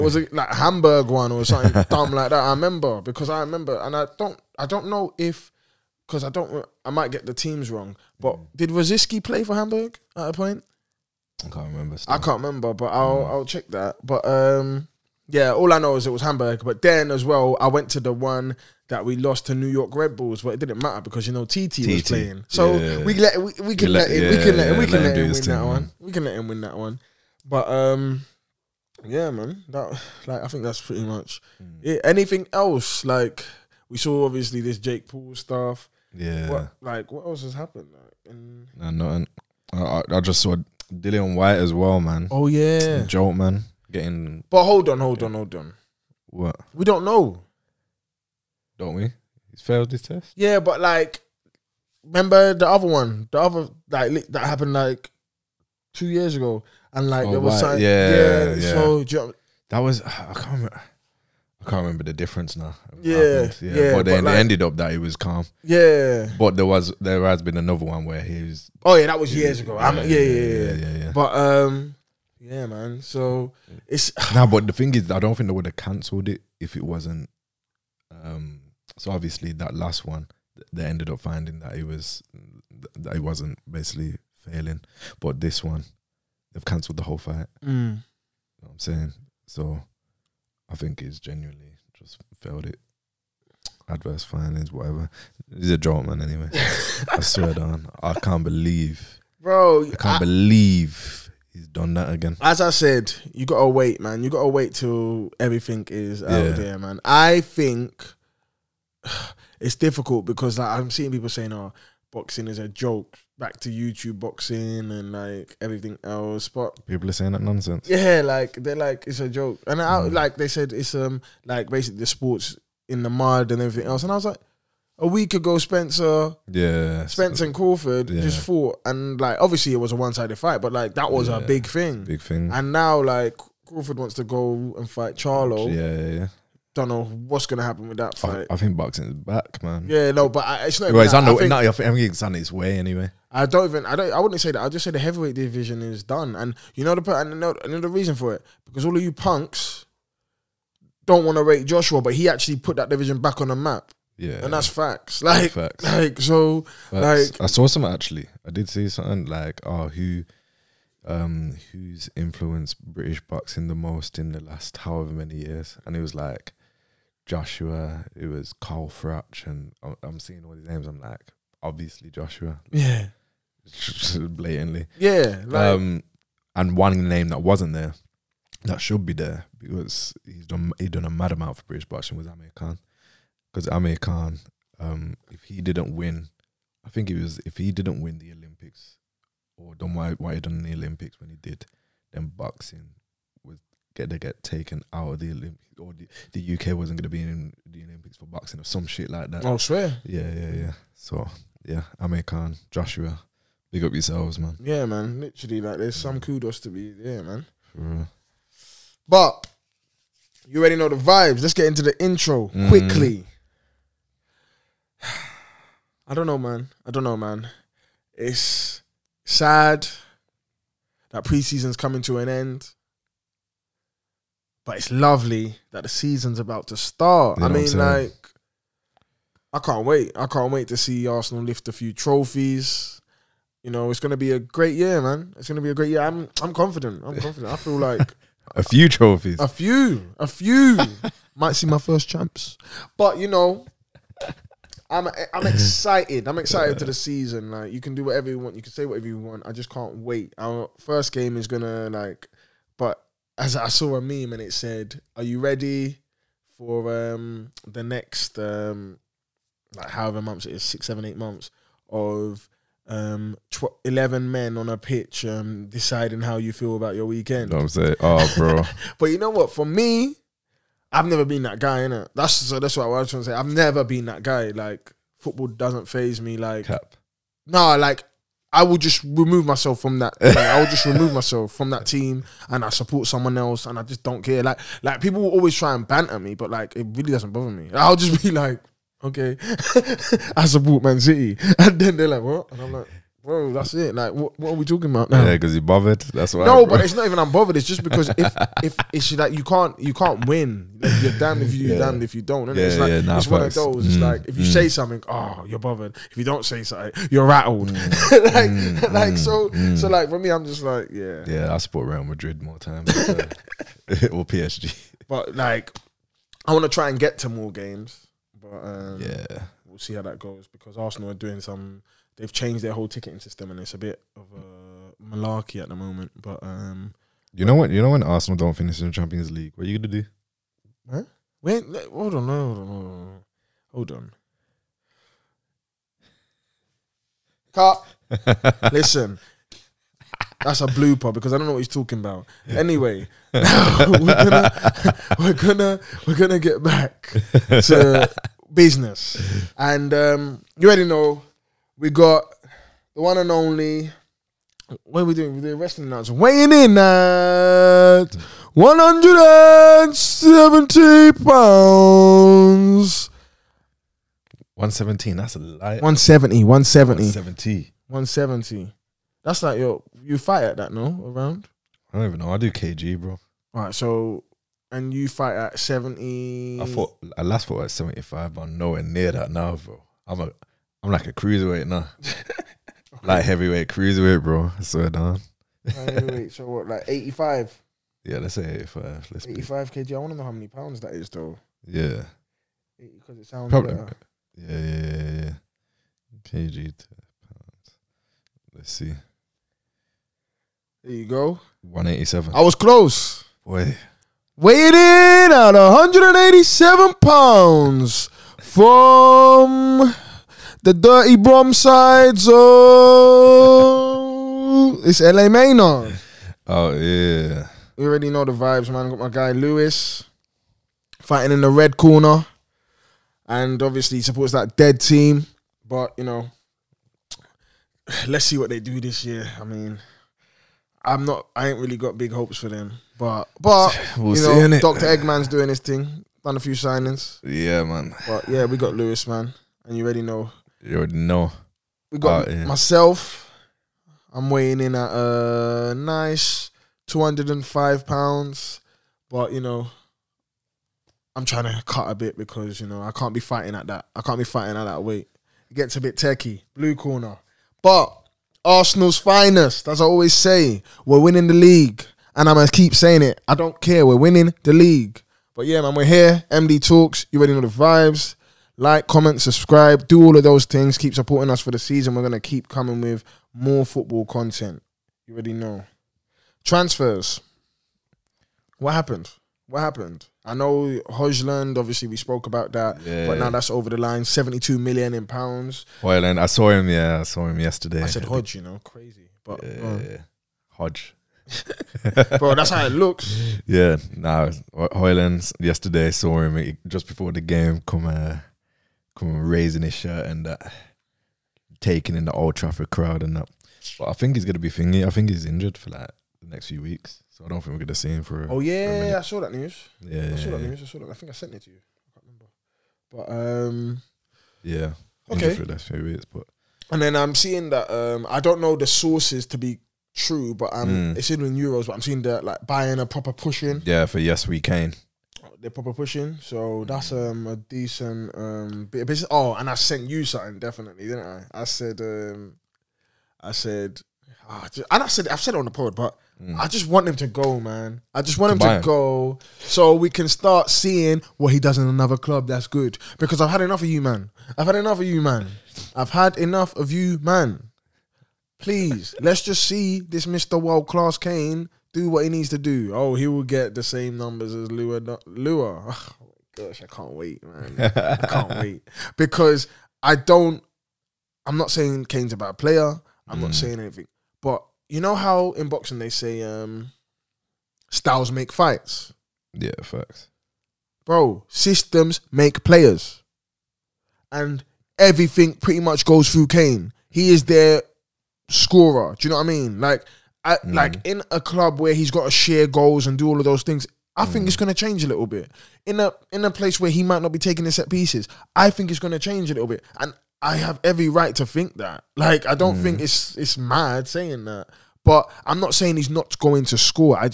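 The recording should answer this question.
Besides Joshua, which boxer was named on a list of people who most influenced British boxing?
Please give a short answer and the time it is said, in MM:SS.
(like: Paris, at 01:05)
Carl Froch, at 02:48.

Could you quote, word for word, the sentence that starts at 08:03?
but now that's over the line, 72 million in pounds.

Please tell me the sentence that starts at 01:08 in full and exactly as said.
Oh yeah, that was years ago.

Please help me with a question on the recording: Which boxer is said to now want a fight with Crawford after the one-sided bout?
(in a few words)
Charlo.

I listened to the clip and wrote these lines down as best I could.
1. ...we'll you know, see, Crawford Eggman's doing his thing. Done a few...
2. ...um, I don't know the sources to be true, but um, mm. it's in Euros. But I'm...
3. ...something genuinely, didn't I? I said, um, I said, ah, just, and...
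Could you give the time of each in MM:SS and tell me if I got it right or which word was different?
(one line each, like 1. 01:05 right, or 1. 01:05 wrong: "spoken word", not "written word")
1. 07:13 wrong: "Doctor", not "Crawford"
2. 08:37 right
3. 08:50 wrong: "definitely", not "genuinely".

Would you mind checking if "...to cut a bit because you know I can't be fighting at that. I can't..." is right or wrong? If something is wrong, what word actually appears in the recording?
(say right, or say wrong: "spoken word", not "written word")
right.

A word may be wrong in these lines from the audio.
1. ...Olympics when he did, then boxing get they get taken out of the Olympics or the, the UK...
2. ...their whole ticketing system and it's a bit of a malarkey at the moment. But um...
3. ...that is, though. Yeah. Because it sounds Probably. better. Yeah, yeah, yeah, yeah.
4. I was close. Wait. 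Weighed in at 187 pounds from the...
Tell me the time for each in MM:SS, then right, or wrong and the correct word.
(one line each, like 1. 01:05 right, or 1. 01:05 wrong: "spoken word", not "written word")
1. 03:10 right
2. 05:22 right
3. 06:30 right
4. 06:42 right.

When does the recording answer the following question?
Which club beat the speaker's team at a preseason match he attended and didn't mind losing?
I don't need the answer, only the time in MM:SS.
00:19.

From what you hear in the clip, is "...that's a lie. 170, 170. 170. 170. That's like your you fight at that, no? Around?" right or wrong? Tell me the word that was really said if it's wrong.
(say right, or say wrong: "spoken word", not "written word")
right.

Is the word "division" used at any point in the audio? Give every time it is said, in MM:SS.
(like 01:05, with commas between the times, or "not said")
02:25, 02:32.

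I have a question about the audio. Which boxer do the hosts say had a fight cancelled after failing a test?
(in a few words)
Dillian Whyte.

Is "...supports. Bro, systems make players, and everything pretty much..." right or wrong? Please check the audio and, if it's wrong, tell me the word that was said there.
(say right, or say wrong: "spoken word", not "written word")
wrong: "facts", not "supports".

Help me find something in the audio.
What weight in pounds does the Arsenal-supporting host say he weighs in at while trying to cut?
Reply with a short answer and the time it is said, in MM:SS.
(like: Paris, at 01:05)
205, at 07:26.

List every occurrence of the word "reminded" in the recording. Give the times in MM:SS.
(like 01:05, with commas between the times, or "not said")
not said.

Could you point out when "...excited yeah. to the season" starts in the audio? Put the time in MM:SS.
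04:06.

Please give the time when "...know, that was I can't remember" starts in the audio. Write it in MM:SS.
00:59.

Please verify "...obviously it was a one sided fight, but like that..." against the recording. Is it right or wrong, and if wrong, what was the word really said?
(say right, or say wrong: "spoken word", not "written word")
right.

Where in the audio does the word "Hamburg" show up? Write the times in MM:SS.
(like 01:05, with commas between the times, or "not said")
00:00, 00:09, 00:16.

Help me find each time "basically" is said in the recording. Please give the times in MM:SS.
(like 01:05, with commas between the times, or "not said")
01:23, 02:01.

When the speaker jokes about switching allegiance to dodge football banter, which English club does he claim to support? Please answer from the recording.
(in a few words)
Man City.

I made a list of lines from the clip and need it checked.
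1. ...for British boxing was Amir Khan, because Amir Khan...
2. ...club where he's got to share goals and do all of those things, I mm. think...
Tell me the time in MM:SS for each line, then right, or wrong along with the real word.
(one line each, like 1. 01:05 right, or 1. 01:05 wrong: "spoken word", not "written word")
1. 03:01 right
2. 09:41 right.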